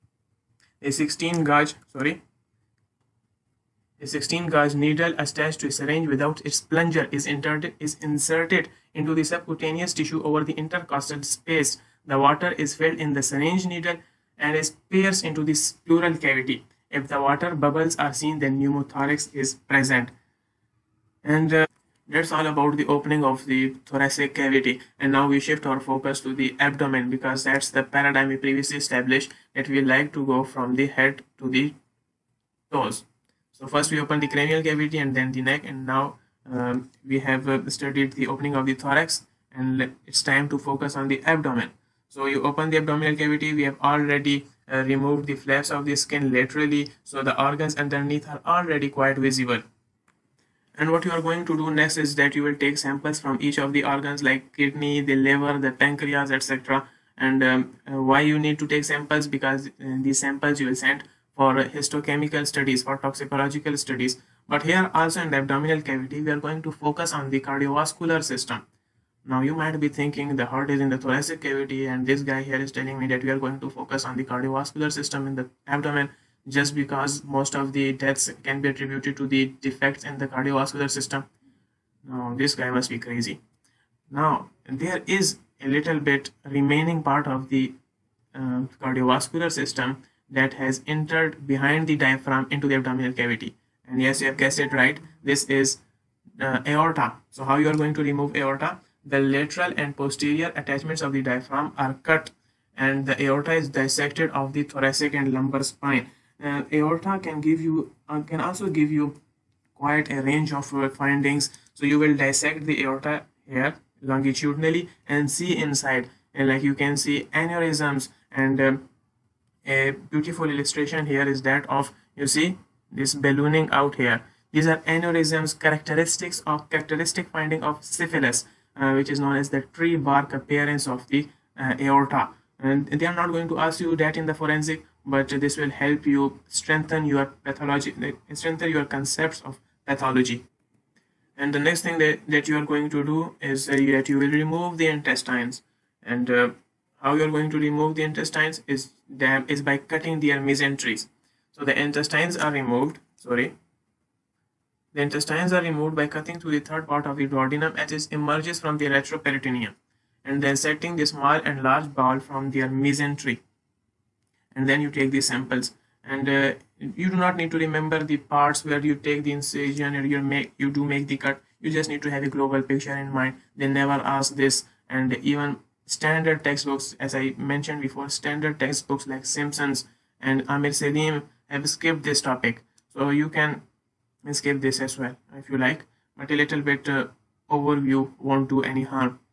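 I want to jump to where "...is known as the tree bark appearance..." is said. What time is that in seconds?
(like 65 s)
129 s.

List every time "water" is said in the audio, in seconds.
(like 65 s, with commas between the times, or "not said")
12 s, 17 s.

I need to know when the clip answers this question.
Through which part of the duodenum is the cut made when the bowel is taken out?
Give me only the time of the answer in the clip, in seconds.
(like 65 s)
156 s.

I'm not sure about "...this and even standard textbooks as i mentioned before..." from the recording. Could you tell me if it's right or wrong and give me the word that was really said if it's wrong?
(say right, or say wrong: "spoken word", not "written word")
right.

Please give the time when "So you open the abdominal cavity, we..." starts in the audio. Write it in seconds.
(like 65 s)
42 s.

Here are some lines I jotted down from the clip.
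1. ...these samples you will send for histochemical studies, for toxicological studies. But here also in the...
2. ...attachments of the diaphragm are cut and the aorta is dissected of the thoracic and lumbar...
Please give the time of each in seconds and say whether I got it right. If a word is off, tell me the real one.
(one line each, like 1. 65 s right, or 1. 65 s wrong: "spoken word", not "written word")
1. 59 s right
2. 100 s right.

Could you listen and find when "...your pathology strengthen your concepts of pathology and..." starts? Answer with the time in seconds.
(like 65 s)
137 s.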